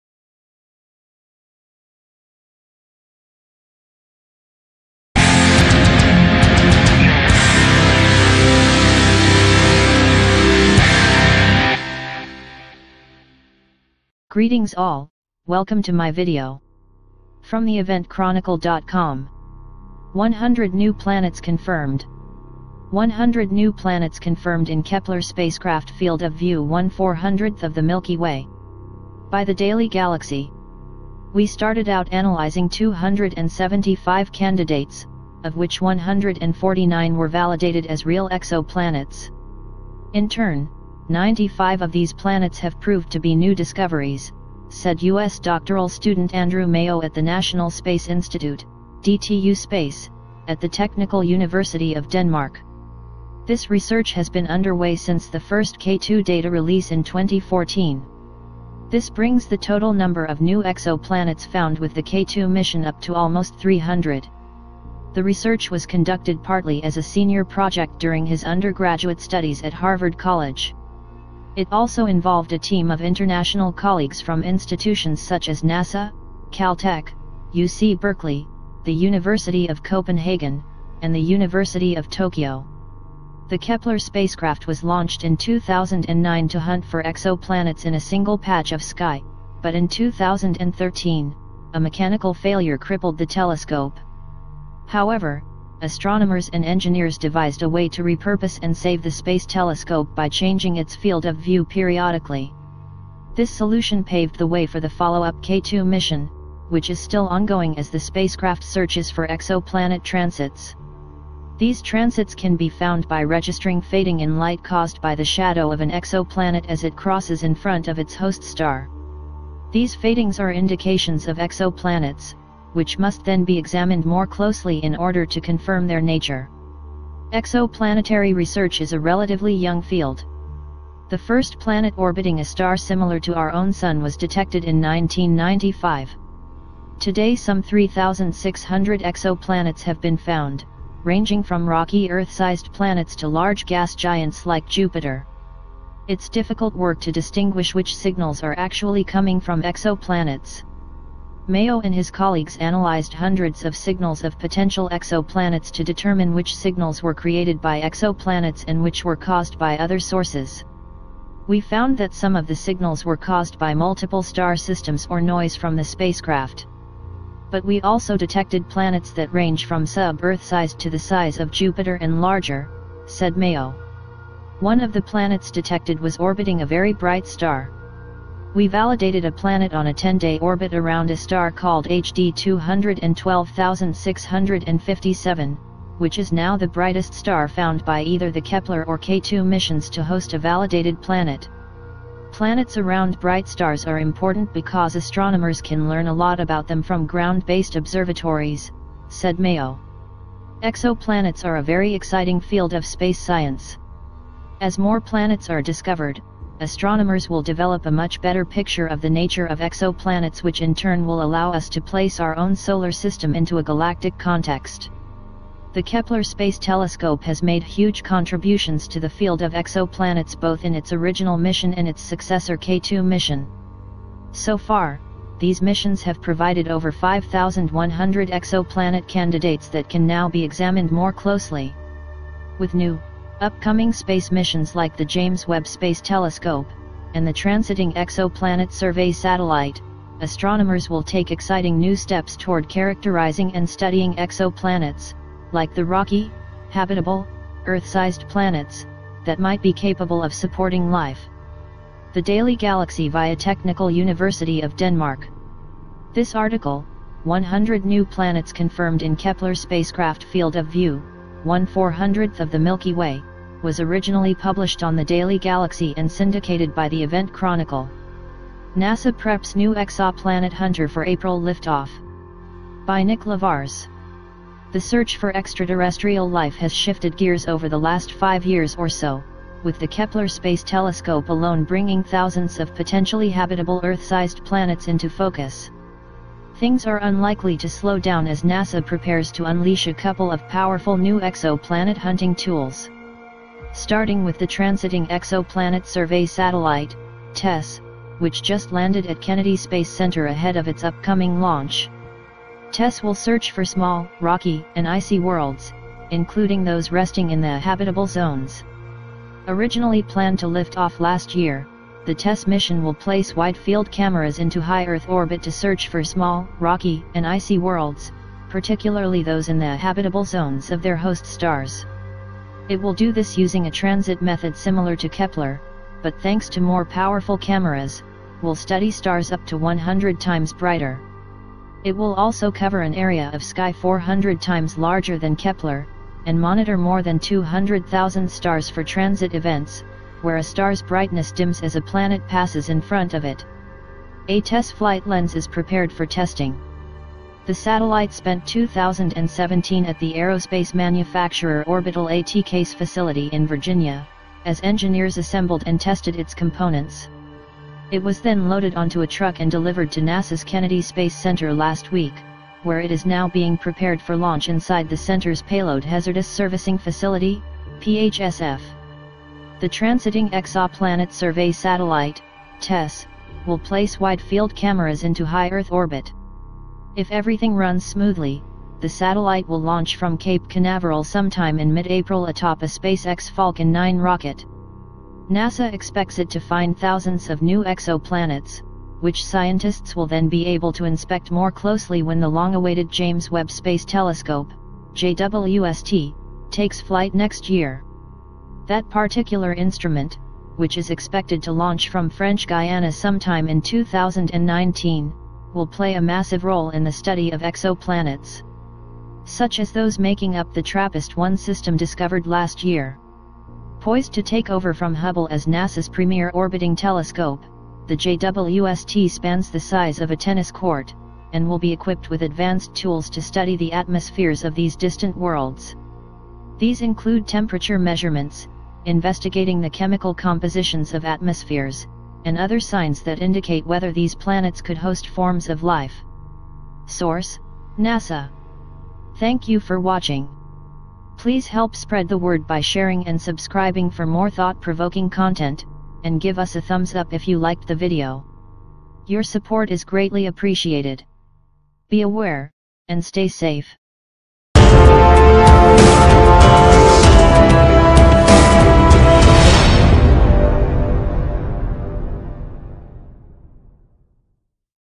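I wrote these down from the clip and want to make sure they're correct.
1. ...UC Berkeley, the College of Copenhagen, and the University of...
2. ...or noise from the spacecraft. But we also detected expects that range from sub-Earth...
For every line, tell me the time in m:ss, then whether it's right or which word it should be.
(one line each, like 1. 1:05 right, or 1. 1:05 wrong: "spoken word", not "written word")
1. 1:17 wrong: "University", not "College"
2. 2:45 wrong: "planets", not "expects".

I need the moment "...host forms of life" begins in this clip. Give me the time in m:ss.
7:14.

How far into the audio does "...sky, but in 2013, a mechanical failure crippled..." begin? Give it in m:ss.
1:28.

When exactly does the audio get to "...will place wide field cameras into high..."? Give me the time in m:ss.
5:12.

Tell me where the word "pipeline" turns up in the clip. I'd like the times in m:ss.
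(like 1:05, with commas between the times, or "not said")
not said.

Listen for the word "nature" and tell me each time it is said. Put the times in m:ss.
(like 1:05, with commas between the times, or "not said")
2:06, 3:29.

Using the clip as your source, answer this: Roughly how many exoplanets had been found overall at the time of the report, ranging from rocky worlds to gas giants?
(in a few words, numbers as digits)
3,600.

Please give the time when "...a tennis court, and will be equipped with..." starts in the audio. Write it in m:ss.
7:00.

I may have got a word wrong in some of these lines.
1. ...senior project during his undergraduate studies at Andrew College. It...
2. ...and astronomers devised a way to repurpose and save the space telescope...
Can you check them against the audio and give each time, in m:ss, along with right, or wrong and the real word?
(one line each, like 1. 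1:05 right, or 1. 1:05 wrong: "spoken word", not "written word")
1. 1:07 wrong: "Harvard", not "Andrew"
2. 1:36 wrong: "engineers", not "astronomers".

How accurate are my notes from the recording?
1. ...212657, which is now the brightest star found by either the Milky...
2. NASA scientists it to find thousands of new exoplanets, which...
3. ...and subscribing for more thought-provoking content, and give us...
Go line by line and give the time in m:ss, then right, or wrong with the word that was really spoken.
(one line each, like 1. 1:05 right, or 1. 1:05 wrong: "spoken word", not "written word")
1. 3:02 wrong: "Kepler", not "Milky"
2. 6:25 wrong: "expects", not "scientists"
3. 7:23 right.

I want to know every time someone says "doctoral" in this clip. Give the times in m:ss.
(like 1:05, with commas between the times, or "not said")
0:45.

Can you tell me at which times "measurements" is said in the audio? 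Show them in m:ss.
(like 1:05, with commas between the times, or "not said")
7:07.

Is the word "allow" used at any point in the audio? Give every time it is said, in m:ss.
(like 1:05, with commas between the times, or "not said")
3:31.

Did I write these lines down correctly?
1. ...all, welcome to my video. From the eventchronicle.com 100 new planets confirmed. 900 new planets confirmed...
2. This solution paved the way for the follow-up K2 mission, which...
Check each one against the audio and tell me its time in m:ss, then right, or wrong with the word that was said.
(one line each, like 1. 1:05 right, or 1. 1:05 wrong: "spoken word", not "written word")
1. 0:14 wrong: "100", not "900"
2. 1:43 right.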